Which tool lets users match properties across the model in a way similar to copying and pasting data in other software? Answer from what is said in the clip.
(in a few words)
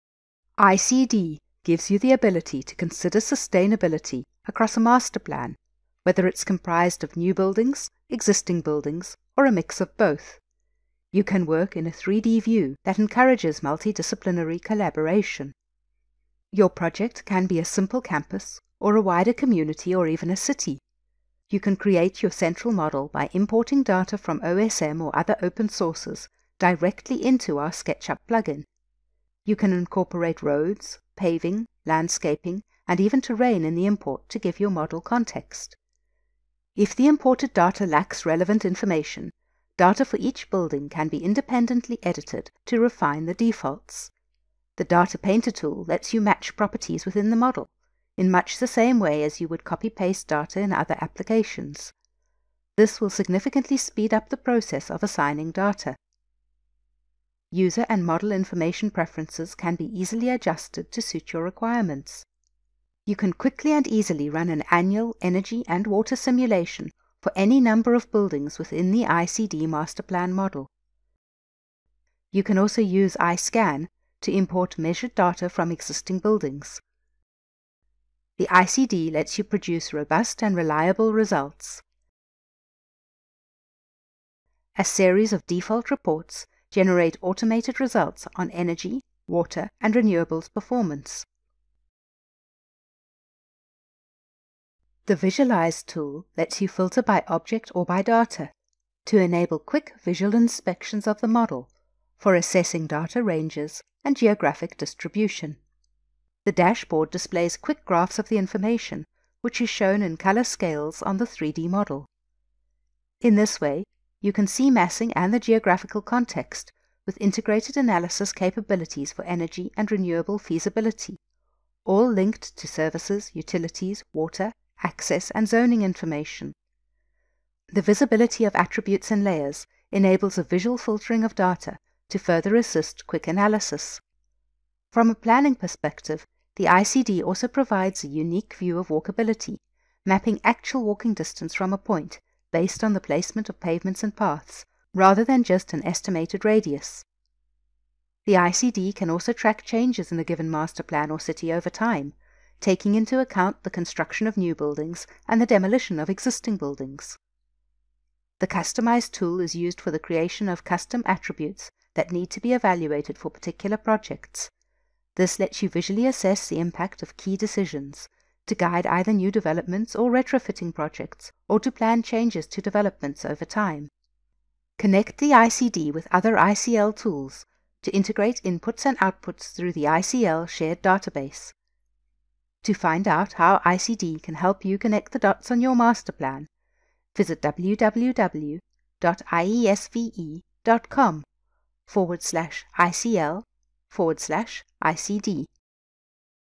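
Data Painter.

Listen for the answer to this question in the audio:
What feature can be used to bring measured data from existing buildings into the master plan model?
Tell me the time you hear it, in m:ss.
1:13.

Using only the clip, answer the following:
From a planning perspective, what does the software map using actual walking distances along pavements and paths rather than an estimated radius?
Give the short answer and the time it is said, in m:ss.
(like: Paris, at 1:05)
walkability, at 2:18.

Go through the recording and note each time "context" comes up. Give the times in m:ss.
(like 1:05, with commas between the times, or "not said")
0:35, 1:56.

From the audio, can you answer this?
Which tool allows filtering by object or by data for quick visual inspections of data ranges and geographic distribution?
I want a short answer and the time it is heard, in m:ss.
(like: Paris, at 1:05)
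Visualize, at 1:35.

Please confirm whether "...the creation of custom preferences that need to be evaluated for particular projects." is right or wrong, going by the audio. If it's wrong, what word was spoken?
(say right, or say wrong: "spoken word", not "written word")
wrong: "attributes", not "preferences".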